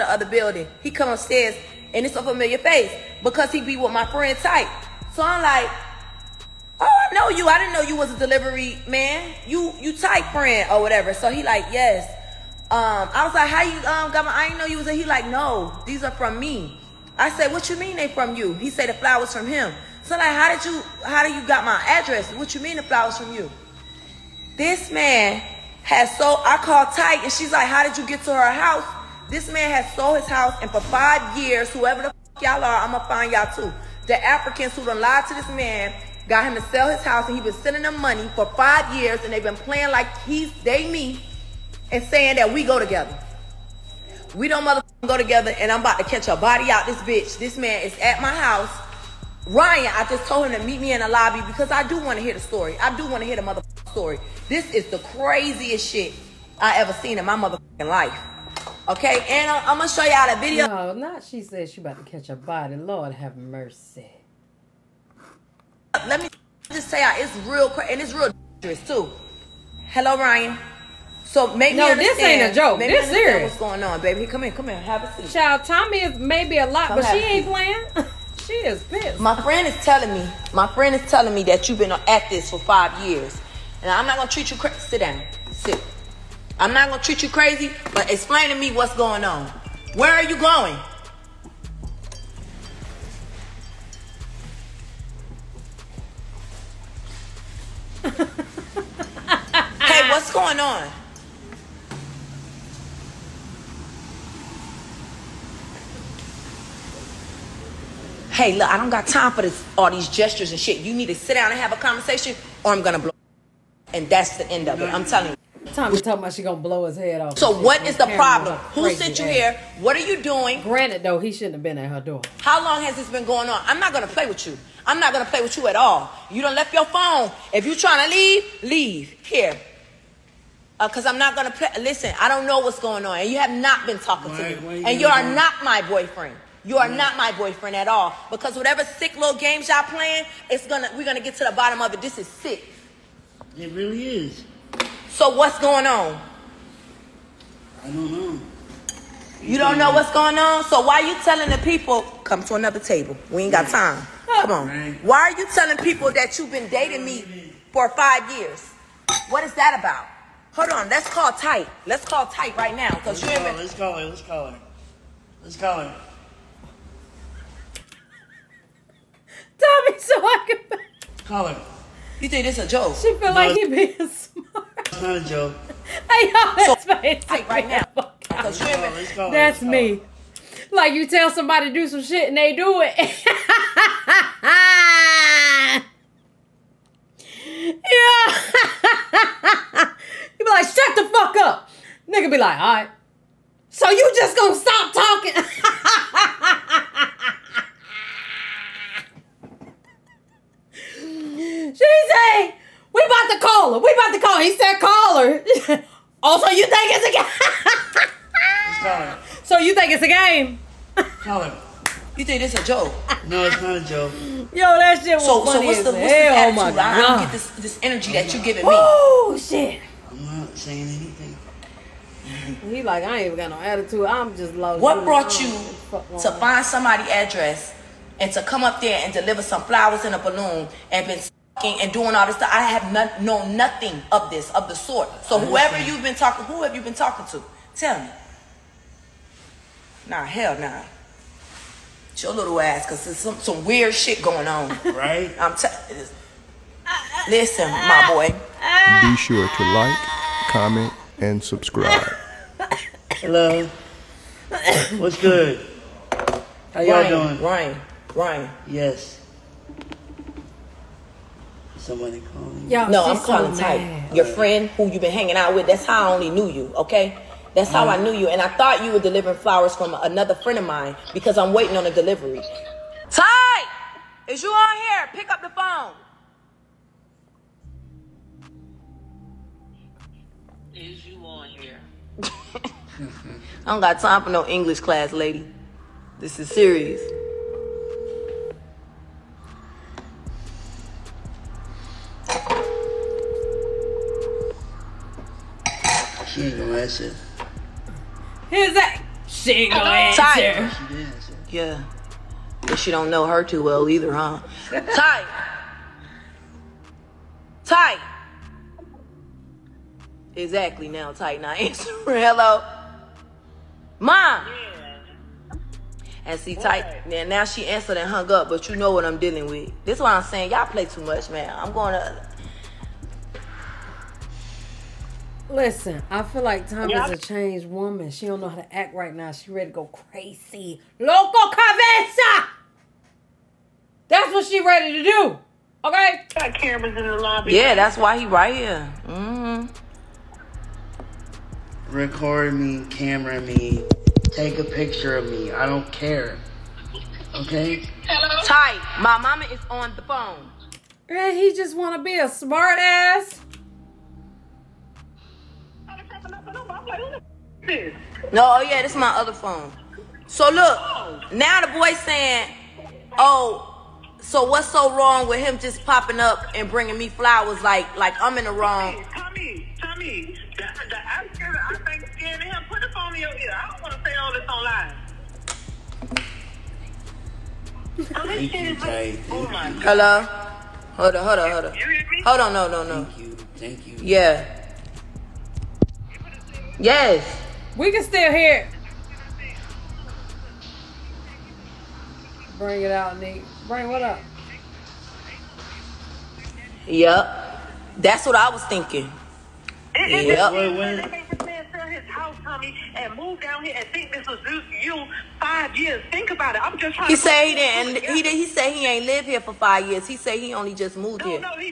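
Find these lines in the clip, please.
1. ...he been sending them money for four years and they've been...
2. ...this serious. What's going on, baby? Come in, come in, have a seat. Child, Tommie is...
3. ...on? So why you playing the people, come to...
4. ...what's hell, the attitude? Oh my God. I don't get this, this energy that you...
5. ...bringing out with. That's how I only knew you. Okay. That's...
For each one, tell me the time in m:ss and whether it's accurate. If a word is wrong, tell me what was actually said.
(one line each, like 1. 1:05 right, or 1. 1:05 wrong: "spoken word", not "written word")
1. 0:37 wrong: "five", not "four"
2. 1:12 right
3. 2:30 wrong: "telling", not "playing"
4. 3:35 right
5. 4:25 wrong: "hanging", not "bringing".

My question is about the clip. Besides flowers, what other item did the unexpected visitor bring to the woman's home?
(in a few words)
a balloon.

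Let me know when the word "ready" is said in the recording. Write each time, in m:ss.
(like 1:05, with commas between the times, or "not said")
5:29, 5:34.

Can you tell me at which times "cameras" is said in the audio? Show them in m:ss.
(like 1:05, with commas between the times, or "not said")
5:36, 5:42.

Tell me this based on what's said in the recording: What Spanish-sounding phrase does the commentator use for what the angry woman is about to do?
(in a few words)
Loco cabeza.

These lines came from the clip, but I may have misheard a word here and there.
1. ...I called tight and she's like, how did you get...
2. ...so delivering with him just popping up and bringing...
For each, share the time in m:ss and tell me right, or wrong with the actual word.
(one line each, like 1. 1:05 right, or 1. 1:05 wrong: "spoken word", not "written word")
1. 0:26 right
2. 6:04 wrong: "wrong", not "delivering".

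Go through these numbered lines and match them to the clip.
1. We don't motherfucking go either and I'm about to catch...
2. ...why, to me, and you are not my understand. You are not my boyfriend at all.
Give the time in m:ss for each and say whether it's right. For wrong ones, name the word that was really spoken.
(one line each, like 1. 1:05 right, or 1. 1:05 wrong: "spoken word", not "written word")
1. 0:44 wrong: "together", not "either"
2. 2:14 wrong: "boyfriend", not "understand".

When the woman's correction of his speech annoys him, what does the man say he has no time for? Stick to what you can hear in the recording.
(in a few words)
English class.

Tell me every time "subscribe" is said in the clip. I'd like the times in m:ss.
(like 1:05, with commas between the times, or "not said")
4:11.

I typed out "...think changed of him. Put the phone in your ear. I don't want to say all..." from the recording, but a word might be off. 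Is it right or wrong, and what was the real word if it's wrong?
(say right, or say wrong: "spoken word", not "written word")
wrong: "scared", not "changed".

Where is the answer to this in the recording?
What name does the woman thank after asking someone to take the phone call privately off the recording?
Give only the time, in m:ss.
6:18.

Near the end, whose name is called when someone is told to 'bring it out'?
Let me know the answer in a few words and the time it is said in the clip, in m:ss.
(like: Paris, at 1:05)
Nick, at 6:33.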